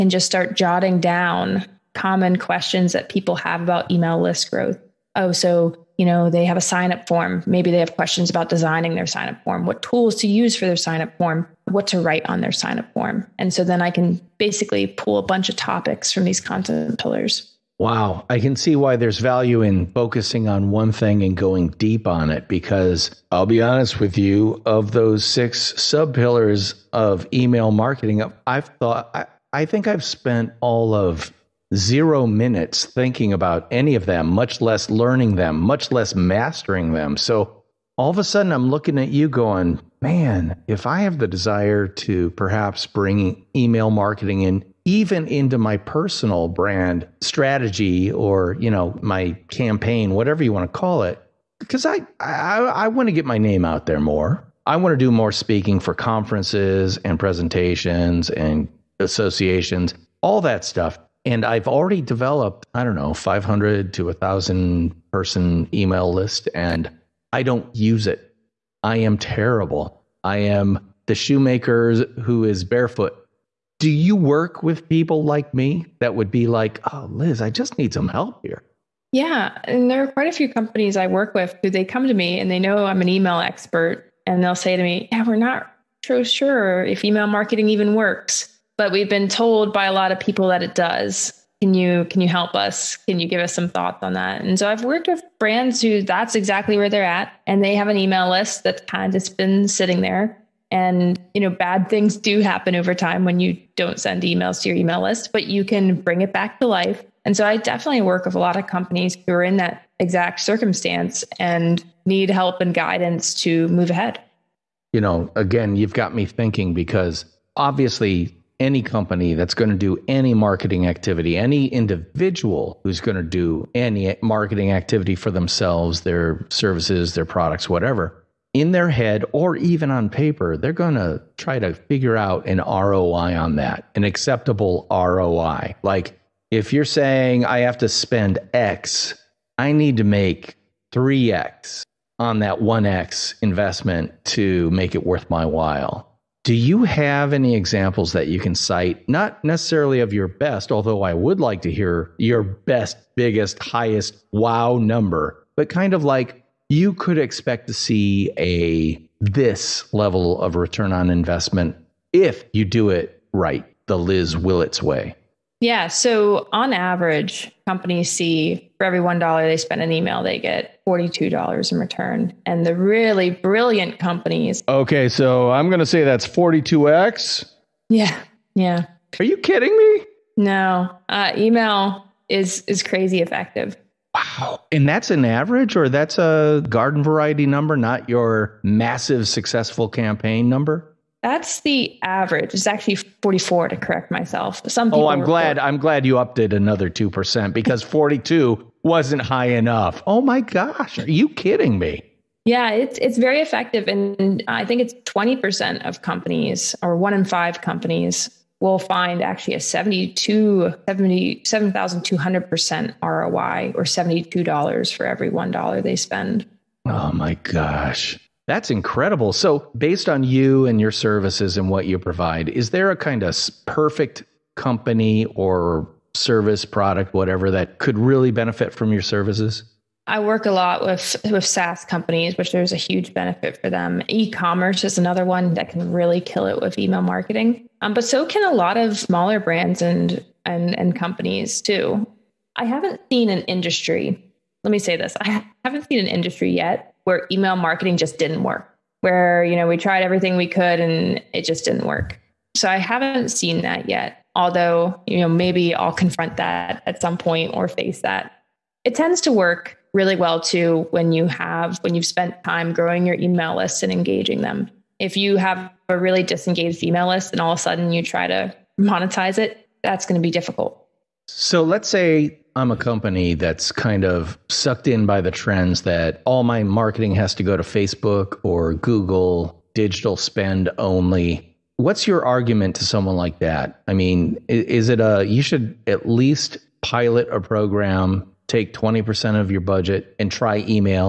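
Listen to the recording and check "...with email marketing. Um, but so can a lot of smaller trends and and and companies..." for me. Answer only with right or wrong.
wrong.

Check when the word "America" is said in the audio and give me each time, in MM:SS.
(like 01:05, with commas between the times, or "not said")
not said.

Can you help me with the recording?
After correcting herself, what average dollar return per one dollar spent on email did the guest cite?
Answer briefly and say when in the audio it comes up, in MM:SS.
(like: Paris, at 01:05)
$44, at 03:12.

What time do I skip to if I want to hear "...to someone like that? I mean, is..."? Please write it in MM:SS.
04:42.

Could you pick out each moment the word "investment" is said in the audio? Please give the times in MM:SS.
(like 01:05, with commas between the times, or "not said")
02:23, 02:41.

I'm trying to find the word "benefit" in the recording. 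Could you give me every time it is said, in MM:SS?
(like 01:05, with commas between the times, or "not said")
03:48, 03:53.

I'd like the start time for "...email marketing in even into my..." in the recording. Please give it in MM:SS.
00:43.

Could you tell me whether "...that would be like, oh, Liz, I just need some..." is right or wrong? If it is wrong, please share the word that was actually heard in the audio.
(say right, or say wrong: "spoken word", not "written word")
right.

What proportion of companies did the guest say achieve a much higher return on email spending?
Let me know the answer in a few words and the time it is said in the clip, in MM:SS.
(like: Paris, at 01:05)
1 in 5, at 03:26.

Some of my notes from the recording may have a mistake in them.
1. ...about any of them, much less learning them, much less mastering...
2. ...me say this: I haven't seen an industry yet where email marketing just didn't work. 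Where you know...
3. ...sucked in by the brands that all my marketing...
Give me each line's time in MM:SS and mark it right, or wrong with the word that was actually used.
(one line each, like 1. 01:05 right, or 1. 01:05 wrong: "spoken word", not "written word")
1. 00:33 right
2. 04:04 right
3. 04:34 wrong: "trends", not "brands".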